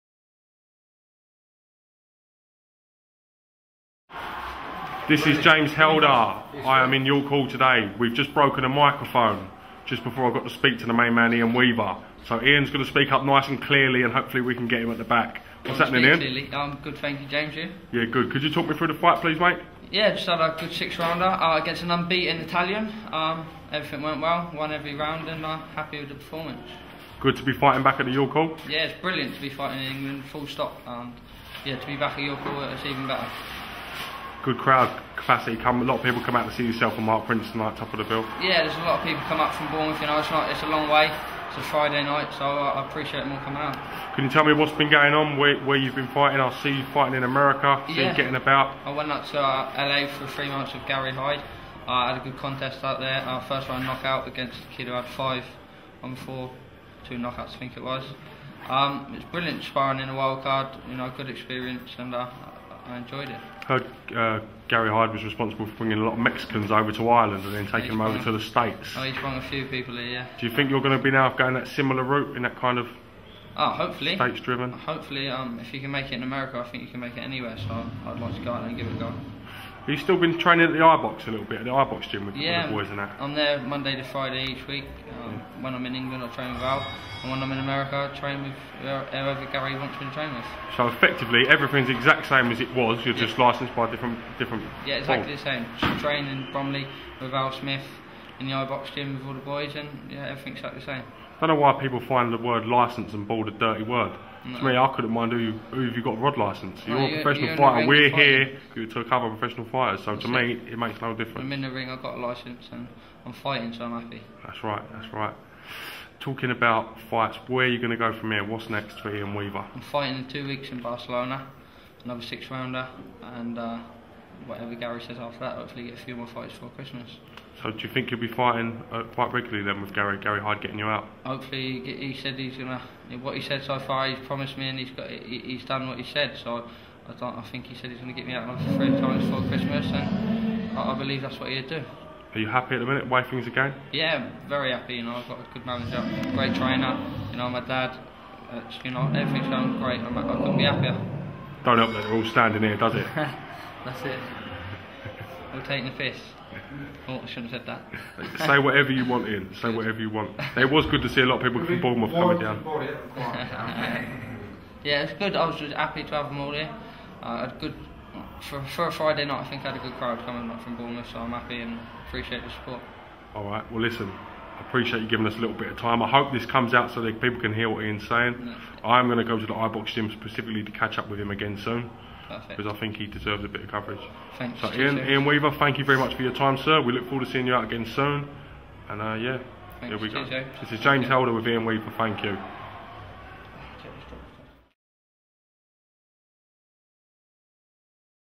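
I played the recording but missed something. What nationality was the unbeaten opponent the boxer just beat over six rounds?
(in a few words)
Italian.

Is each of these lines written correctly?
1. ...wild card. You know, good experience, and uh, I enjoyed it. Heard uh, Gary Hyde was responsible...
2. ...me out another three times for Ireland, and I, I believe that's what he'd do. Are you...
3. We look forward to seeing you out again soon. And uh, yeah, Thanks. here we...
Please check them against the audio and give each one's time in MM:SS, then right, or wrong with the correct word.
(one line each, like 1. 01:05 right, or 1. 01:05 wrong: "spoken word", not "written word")
1. 01:00 right
2. 02:18 wrong: "Christmas", not "Ireland"
3. 03:06 right.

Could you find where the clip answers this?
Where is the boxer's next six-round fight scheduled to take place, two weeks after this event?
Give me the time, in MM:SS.
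02:00.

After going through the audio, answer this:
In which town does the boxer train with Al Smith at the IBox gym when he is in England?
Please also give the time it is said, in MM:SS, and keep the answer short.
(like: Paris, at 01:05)
Bromley, at 01:36.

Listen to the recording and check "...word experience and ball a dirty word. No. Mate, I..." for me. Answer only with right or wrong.
wrong.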